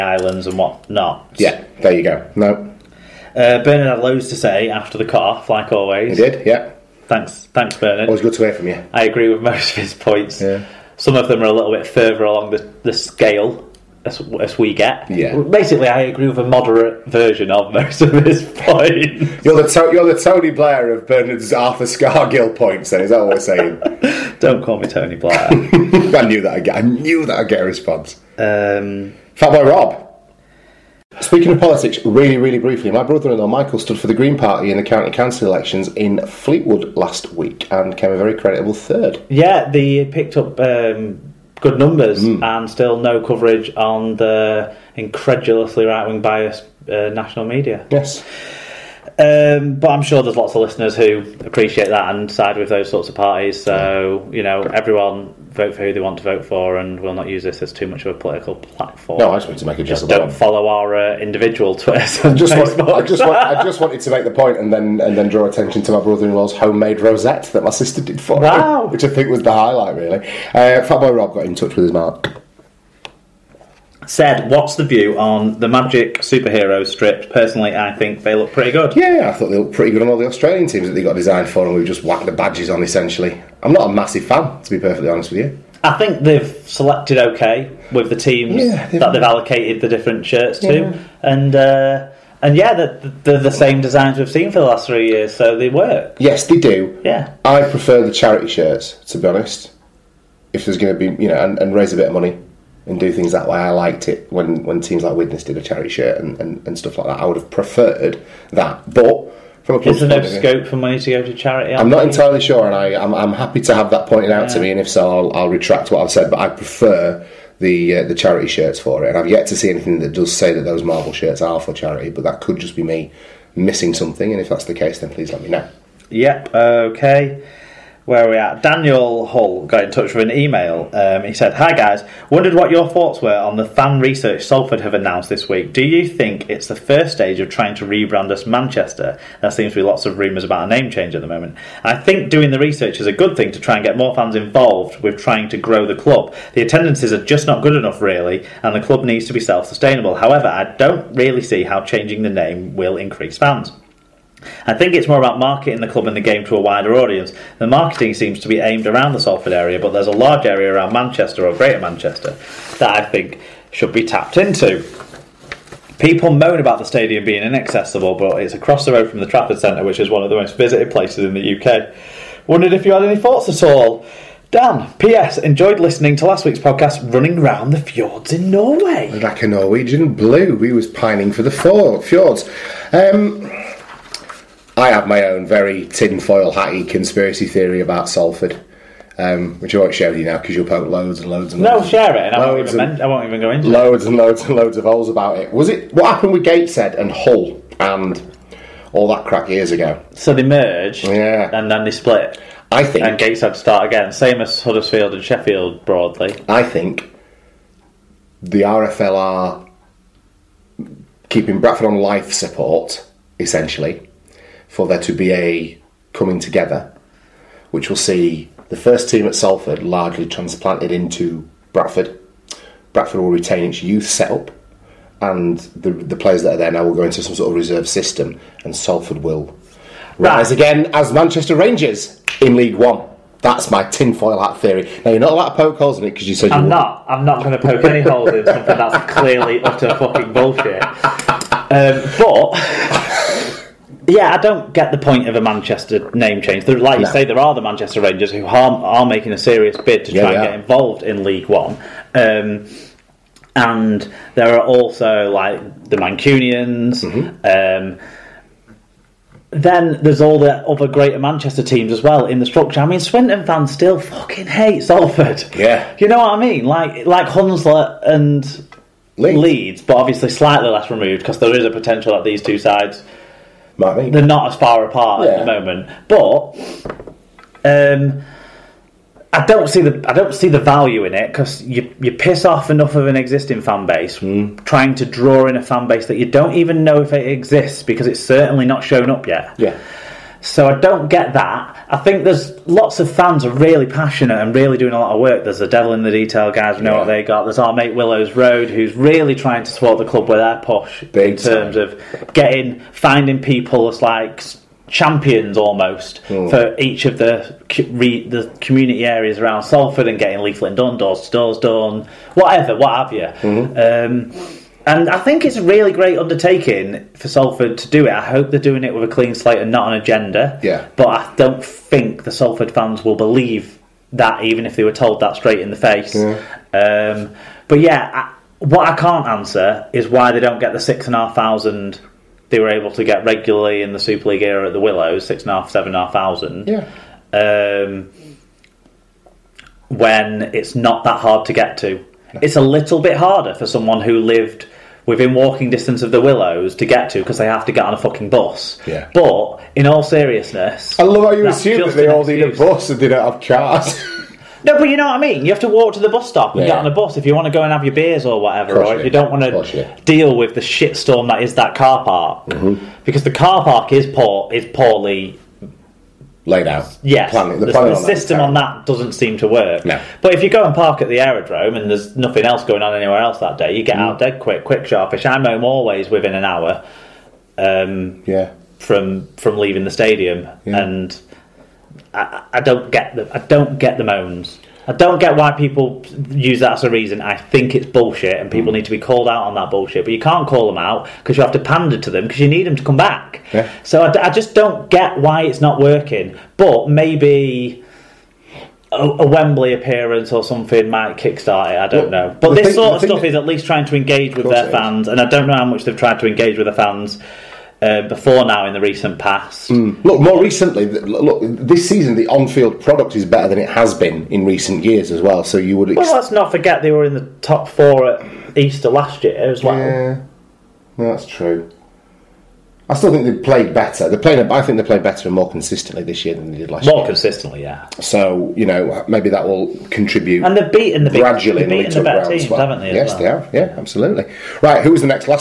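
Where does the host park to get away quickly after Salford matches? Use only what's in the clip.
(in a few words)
the aerodrome.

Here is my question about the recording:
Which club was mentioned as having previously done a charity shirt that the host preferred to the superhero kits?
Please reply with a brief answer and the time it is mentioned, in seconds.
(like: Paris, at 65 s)
Widnes, at 105 s.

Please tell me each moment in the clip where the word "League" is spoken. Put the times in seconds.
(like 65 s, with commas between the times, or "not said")
232 s, 251 s, 334 s.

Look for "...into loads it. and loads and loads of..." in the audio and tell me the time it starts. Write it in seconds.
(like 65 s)
193 s.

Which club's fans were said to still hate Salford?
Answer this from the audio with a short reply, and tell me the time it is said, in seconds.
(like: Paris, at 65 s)
Swinton, at 263 s.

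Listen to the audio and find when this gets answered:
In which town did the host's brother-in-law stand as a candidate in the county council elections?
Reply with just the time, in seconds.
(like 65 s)
36 s.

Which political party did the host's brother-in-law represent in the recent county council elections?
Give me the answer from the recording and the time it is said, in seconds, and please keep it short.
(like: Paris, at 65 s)
Green Party, at 34 s.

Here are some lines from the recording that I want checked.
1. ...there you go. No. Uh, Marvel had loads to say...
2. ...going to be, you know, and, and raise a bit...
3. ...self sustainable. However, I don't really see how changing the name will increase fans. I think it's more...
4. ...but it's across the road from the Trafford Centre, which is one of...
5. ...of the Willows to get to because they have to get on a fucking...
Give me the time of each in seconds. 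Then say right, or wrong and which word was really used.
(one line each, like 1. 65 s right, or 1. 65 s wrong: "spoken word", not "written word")
1. 1 s wrong: "Bernard", not "Marvel"
2. 100 s right
3. 149 s right
4. 168 s right
5. 346 s right.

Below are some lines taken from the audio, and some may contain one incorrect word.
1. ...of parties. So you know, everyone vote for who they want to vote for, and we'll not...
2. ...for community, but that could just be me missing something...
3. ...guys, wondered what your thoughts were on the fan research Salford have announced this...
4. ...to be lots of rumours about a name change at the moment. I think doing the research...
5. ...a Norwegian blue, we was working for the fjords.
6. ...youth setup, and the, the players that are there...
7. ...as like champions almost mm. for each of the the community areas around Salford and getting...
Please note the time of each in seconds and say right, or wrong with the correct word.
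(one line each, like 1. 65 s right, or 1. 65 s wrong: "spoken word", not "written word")
1. 53 s right
2. 121 s wrong: "charity", not "community"
3. 131 s right
4. 139 s right
5. 179 s wrong: "pining", not "working"
6. 223 s right
7. 303 s right.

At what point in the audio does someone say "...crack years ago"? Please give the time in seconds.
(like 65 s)
199 s.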